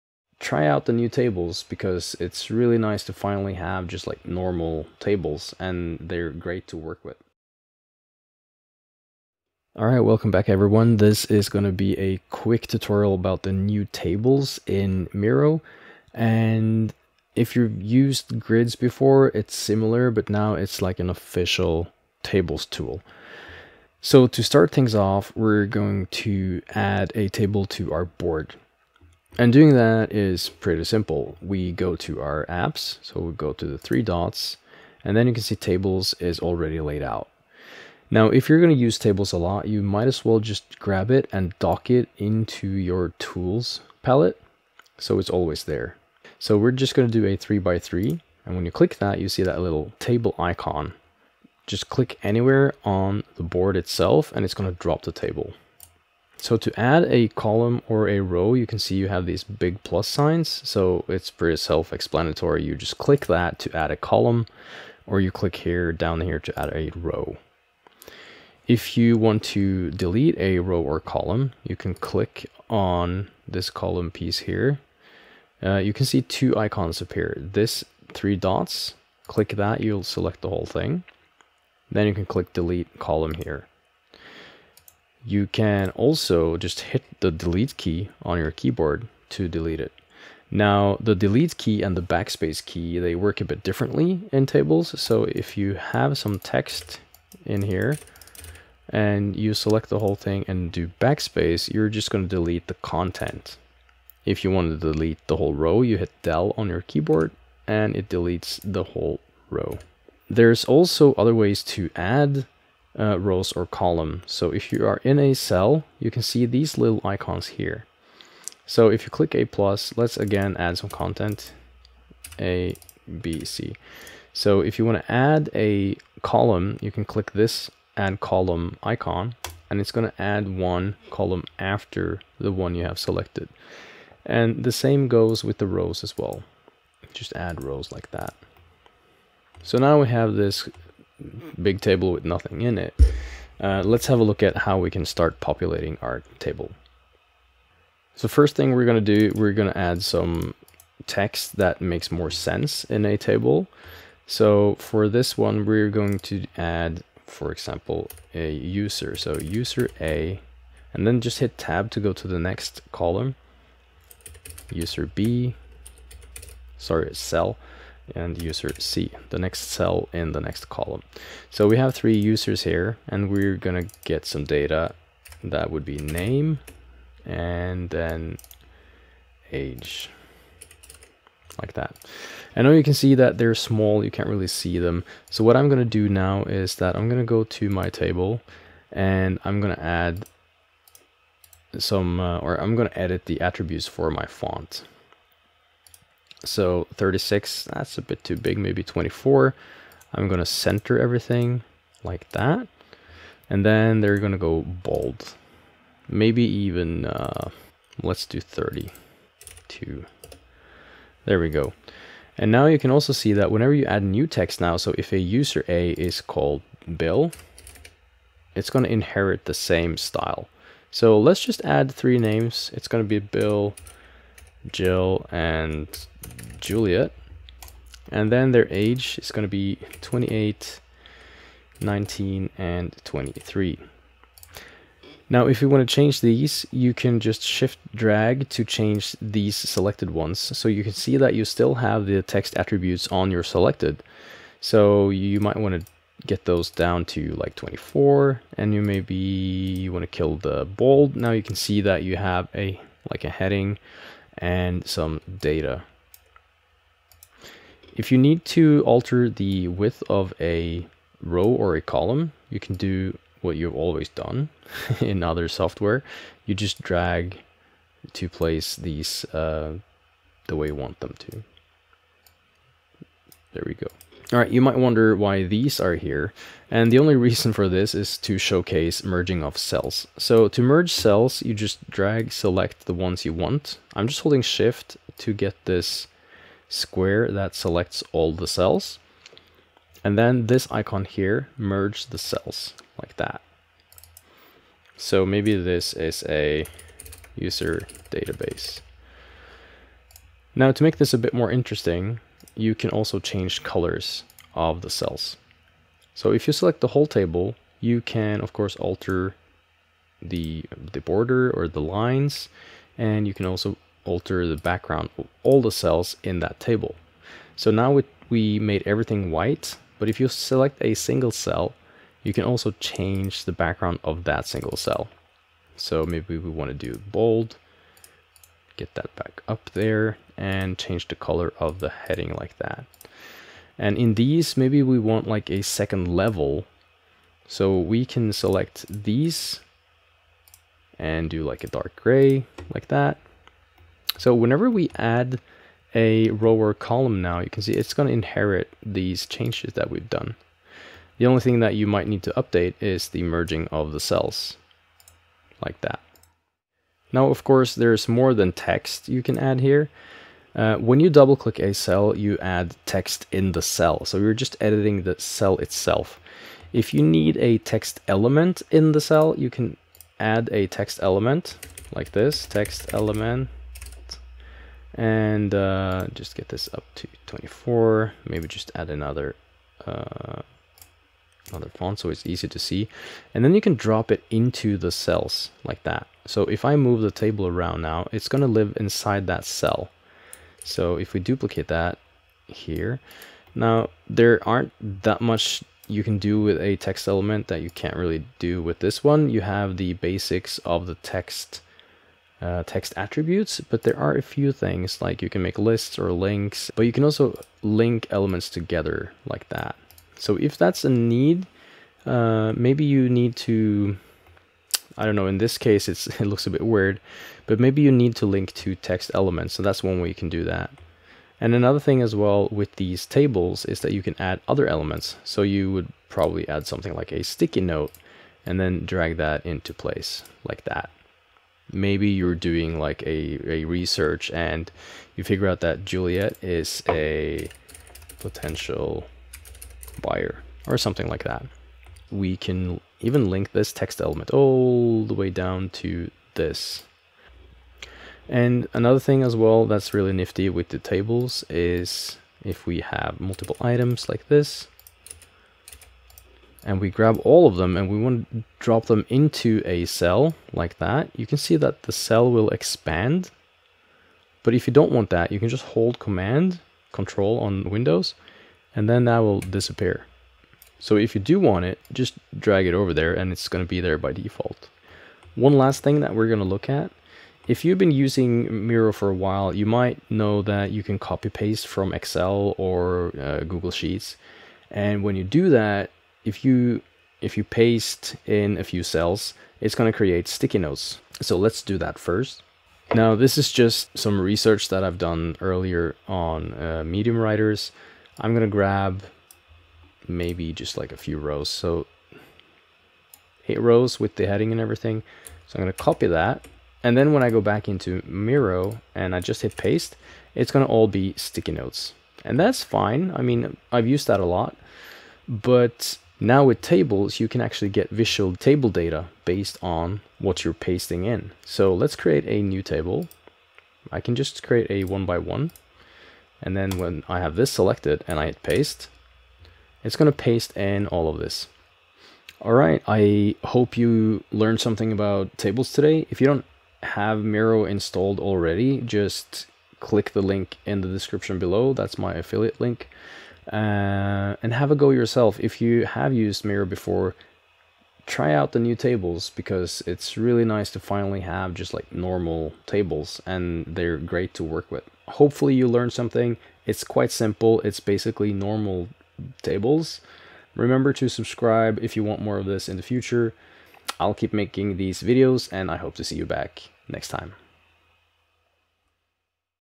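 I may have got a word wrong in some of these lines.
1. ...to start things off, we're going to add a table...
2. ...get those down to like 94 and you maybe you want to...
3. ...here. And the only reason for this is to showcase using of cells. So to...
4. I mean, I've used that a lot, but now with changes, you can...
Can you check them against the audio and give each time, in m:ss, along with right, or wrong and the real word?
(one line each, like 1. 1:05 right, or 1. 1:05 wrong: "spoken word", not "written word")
1. 0:24 right
2. 4:06 wrong: "24", not "94"
3. 4:35 wrong: "merging", not "using"
4. 8:33 wrong: "tables", not "changes".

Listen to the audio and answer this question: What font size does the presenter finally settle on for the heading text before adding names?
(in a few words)
32.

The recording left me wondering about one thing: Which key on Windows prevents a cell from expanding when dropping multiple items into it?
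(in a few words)
control.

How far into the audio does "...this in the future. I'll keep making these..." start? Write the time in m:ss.
9:22.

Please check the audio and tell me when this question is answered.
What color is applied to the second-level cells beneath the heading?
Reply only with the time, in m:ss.
5:41.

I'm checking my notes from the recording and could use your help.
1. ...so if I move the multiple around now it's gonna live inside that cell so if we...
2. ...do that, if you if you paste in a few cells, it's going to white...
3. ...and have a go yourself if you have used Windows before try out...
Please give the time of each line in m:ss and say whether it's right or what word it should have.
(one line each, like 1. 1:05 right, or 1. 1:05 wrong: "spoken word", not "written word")
1. 6:26 wrong: "table", not "multiple"
2. 8:05 wrong: "create", not "white"
3. 9:04 wrong: "Miro", not "Windows".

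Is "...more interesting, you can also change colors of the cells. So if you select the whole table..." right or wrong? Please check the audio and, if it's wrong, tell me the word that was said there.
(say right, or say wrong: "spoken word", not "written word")
right.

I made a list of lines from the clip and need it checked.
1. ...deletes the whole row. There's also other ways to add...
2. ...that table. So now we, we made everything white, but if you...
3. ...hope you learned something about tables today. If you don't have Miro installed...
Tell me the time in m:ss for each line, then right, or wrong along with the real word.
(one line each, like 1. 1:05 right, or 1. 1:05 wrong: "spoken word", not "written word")
1. 1:48 right
2. 5:16 right
3. 8:53 right.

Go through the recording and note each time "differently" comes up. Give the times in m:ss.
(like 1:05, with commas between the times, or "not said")
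1:33.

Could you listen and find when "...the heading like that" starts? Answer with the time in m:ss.
5:31.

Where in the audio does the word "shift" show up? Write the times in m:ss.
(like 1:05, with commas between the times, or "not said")
3:57, 4:44.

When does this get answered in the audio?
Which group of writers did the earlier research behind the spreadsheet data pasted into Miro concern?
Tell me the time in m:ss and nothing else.
8:16.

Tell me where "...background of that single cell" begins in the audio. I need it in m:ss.
5:23.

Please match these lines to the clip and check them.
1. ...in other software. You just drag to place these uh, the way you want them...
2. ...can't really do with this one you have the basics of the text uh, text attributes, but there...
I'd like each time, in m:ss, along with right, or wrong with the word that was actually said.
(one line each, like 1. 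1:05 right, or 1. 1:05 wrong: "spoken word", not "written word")
1. 4:25 right
2. 6:37 right.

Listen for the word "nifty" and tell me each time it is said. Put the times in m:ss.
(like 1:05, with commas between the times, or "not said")
7:30.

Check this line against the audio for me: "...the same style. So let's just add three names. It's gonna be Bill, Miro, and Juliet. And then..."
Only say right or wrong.
wrong.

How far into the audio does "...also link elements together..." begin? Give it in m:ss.
6:47.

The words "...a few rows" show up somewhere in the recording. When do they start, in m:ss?
8:20.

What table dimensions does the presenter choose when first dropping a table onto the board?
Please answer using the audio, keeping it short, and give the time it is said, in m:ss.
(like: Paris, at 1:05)
3 by 3, at 0:47.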